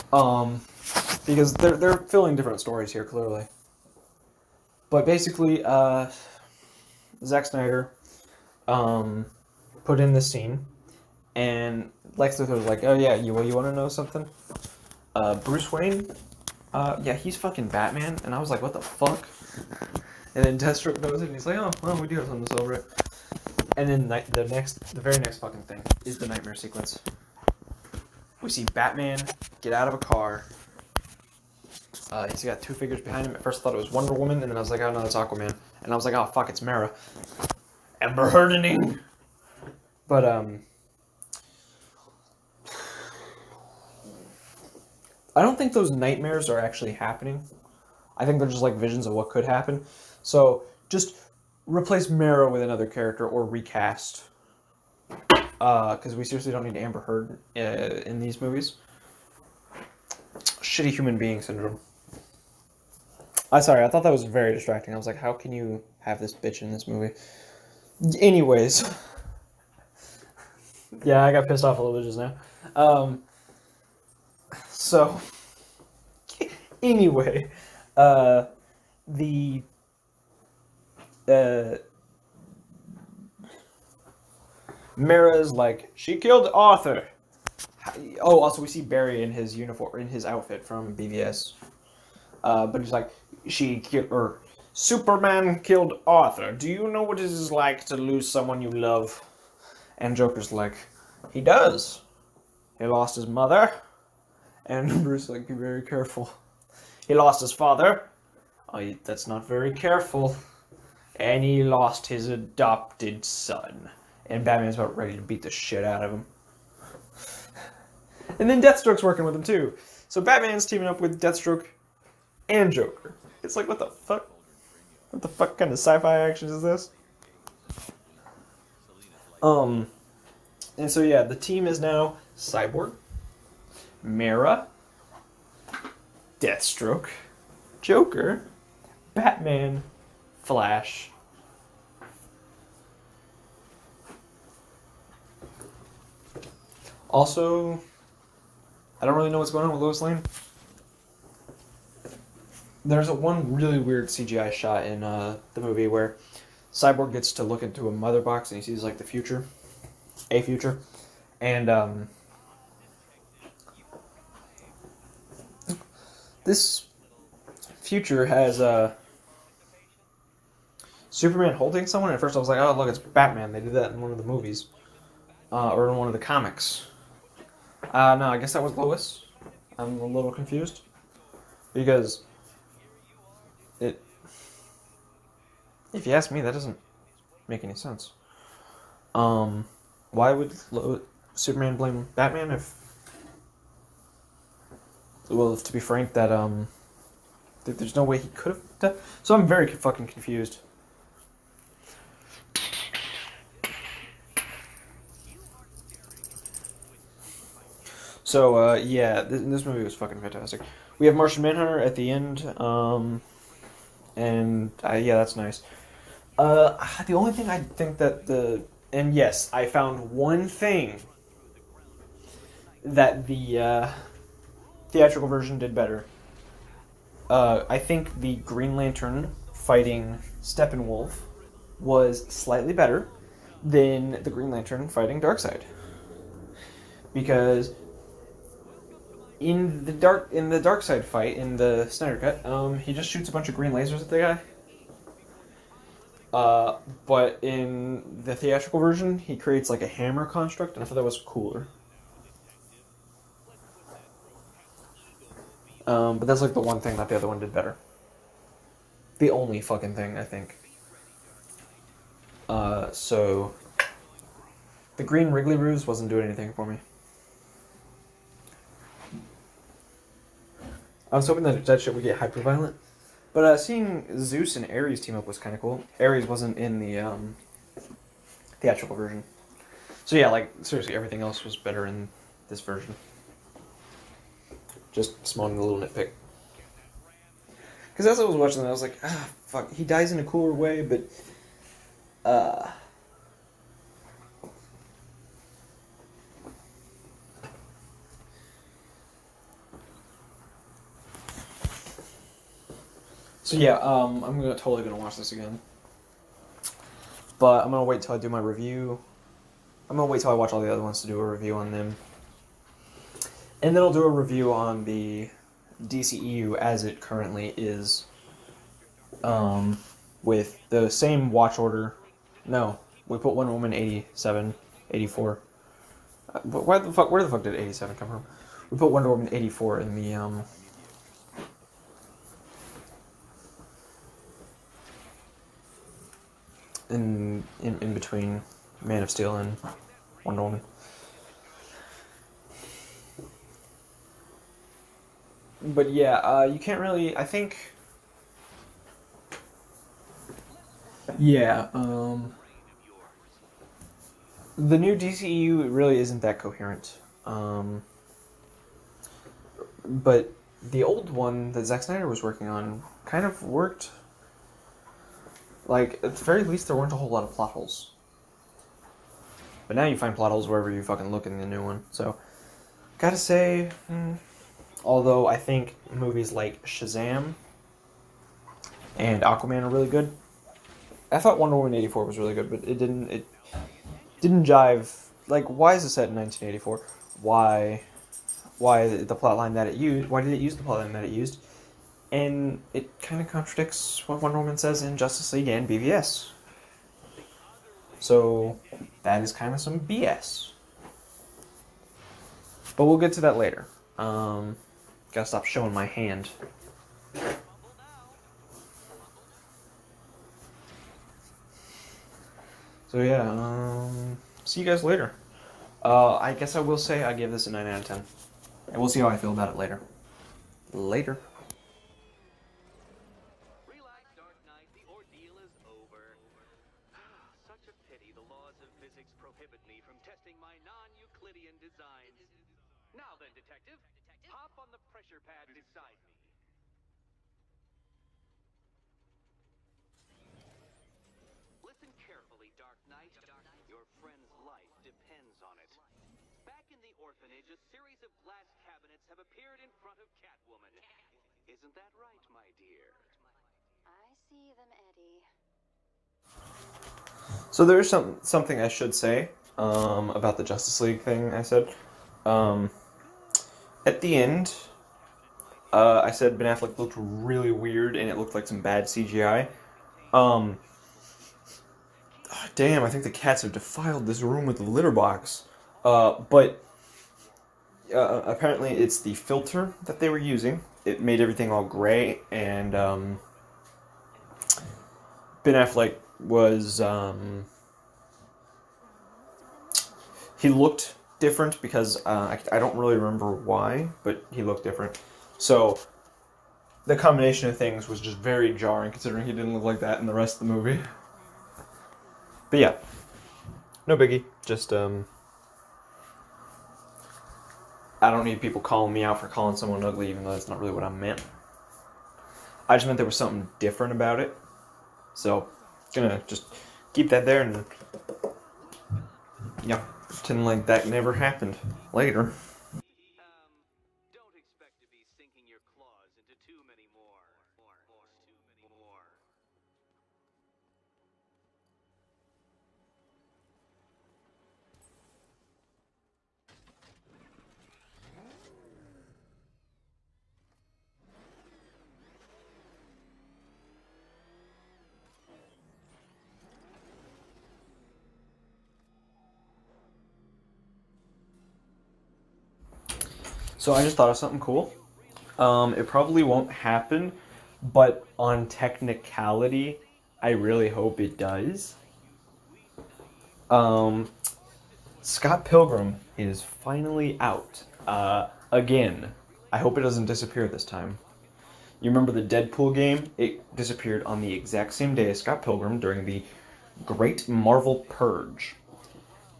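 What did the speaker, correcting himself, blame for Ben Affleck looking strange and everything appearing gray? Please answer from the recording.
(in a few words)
the filter.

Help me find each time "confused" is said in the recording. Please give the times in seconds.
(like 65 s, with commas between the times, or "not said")
180 s, 200 s.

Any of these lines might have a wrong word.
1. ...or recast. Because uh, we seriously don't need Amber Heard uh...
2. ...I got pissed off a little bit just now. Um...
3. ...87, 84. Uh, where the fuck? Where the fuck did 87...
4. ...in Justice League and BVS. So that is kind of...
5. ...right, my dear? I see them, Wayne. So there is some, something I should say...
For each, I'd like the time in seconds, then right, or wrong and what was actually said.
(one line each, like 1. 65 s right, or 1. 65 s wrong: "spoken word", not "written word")
1. 53 s right
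2. 71 s right
3. 323 s right
4. 394 s right
5. 451 s wrong: "Eddie", not "Wayne".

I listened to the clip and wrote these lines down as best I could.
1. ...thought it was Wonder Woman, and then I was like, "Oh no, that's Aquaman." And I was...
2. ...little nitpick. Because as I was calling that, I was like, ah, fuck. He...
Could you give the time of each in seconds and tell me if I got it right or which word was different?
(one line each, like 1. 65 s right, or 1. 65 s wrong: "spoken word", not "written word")
1. 33 s right
2. 285 s wrong: "watching", not "calling".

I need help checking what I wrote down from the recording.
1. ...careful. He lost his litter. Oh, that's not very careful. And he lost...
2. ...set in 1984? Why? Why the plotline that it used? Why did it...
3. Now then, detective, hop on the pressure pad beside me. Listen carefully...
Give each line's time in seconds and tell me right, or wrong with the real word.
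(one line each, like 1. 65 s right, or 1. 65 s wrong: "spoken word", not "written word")
1. 105 s wrong: "father", not "litter"
2. 385 s right
3. 432 s right.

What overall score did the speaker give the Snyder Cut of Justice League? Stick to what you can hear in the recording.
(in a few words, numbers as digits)
9 out of 10.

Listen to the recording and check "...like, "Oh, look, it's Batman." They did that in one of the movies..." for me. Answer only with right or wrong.
right.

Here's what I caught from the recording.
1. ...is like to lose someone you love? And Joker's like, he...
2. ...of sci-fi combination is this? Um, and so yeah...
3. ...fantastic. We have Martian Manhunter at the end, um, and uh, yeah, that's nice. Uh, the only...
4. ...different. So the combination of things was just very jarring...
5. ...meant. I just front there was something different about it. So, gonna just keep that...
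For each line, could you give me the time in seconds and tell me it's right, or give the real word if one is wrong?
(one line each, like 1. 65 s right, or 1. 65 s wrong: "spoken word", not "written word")
1. 97 s right
2. 125 s wrong: "action", not "combination"
3. 210 s right
4. 494 s right
5. 510 s wrong: "meant", not "front".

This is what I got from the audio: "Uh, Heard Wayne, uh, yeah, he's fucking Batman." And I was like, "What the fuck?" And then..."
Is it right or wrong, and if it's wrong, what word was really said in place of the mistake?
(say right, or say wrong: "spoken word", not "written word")
wrong: "Bruce", not "Heard".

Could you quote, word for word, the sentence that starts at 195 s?
Well, if to be frank, that um, there's no way he could have.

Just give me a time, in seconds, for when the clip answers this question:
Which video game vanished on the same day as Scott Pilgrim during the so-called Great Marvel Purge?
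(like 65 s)
572 s.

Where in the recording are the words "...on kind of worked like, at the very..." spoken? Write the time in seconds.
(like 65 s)
362 s.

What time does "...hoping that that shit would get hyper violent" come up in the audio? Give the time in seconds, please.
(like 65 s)
271 s.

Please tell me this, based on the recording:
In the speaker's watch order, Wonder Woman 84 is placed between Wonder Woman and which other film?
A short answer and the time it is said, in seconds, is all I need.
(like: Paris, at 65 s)
Man of Steel, at 338 s.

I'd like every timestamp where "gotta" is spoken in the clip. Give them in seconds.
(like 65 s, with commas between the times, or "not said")
372 s, 405 s.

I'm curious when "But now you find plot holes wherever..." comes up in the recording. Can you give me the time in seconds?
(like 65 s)
369 s.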